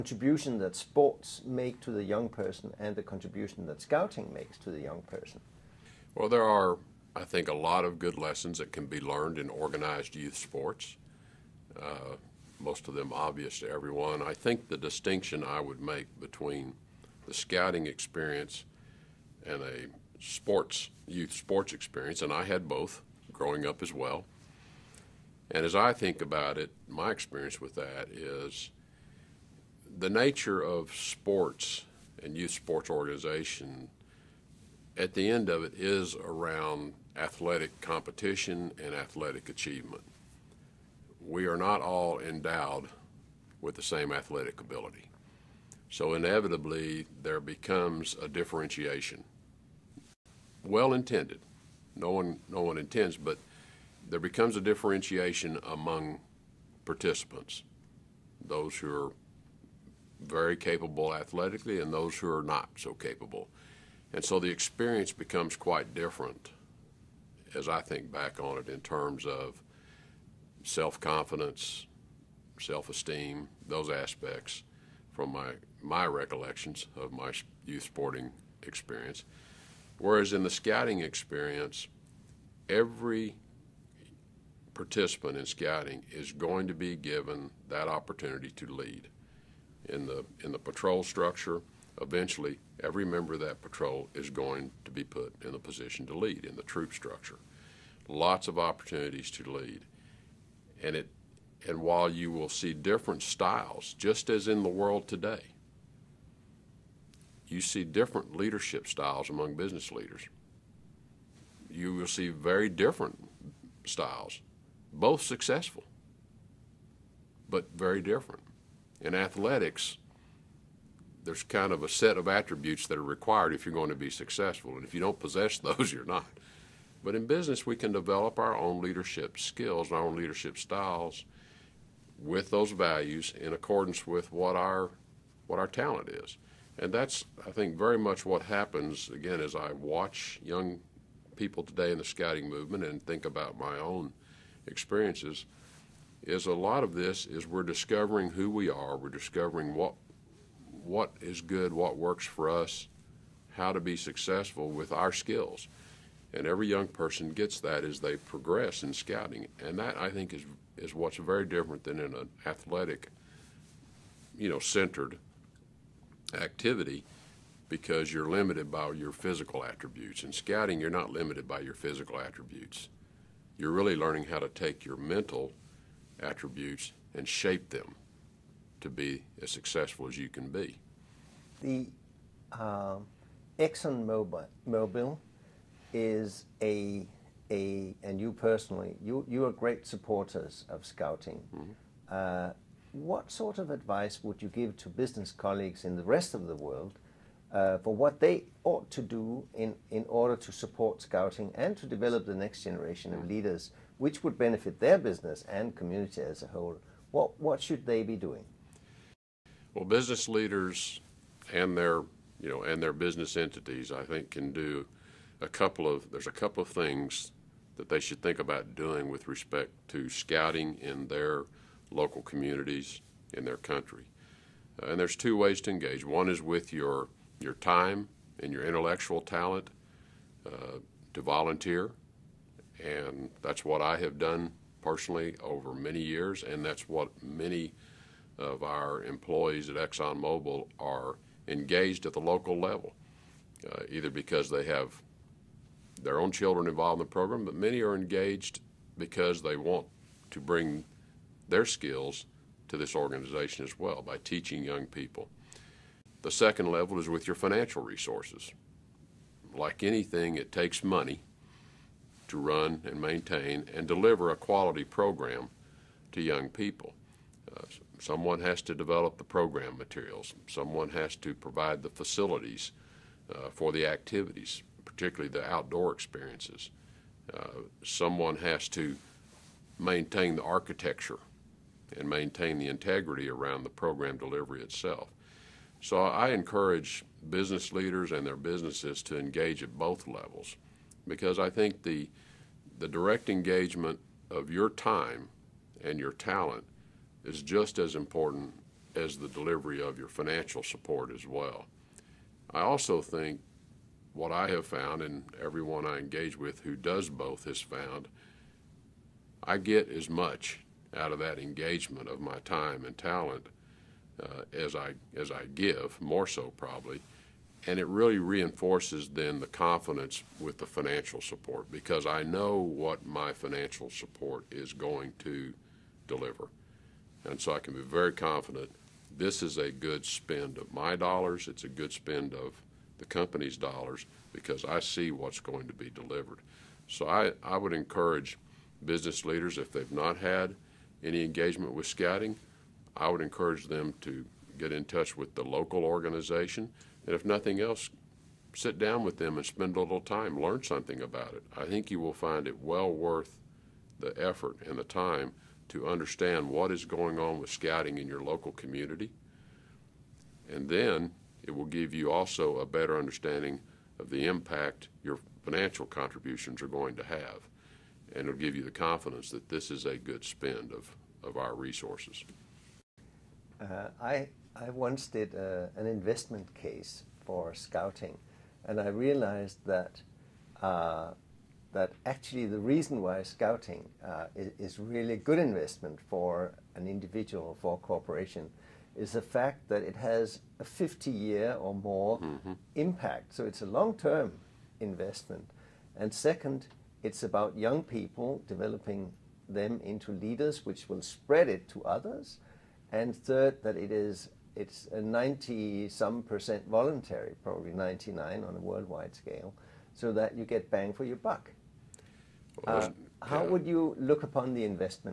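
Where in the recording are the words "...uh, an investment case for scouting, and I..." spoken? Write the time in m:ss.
6:15.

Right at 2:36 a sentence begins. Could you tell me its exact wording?
And every young person gets that as they progress in scouting.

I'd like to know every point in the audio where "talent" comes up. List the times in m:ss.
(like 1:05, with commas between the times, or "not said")
2:15, 3:49, 4:56, 5:12.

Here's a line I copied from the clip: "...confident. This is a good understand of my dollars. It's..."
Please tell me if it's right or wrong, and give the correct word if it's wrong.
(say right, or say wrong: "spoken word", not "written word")
wrong: "spend", not "understand".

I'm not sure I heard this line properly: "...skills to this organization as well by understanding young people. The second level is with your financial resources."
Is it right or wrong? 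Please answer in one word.
wrong.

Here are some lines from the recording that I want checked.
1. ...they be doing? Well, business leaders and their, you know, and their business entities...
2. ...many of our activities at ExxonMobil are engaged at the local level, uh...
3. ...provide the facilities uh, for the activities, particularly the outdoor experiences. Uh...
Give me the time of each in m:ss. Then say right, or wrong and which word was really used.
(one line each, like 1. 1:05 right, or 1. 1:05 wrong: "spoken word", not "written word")
1. 3:27 right
2. 3:57 wrong: "employees", not "activities"
3. 4:31 right.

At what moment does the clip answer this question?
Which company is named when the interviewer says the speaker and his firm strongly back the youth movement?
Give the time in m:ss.
3:03.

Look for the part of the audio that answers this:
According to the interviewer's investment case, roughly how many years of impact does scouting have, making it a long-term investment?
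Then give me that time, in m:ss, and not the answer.
6:30.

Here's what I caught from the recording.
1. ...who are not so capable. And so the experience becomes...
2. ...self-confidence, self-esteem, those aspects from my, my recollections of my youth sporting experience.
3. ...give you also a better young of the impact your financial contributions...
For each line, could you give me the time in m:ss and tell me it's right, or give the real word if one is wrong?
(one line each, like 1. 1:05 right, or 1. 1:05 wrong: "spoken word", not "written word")
1. 1:02 right
2. 1:10 right
3. 6:01 wrong: "understanding", not "young".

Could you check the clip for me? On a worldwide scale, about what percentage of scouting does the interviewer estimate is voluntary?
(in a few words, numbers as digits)
99.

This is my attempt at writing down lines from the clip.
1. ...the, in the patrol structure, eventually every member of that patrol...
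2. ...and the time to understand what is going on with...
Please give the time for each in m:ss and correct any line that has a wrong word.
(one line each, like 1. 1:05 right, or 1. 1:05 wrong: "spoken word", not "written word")
1. 1:30 right
2. 5:54 right.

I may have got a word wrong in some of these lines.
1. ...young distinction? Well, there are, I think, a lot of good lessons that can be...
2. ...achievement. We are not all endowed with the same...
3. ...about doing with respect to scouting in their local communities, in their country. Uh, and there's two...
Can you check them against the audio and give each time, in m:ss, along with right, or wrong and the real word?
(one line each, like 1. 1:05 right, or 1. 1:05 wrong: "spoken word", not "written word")
1. 0:04 wrong: "person", not "distinction"
2. 0:39 right
3. 3:38 right.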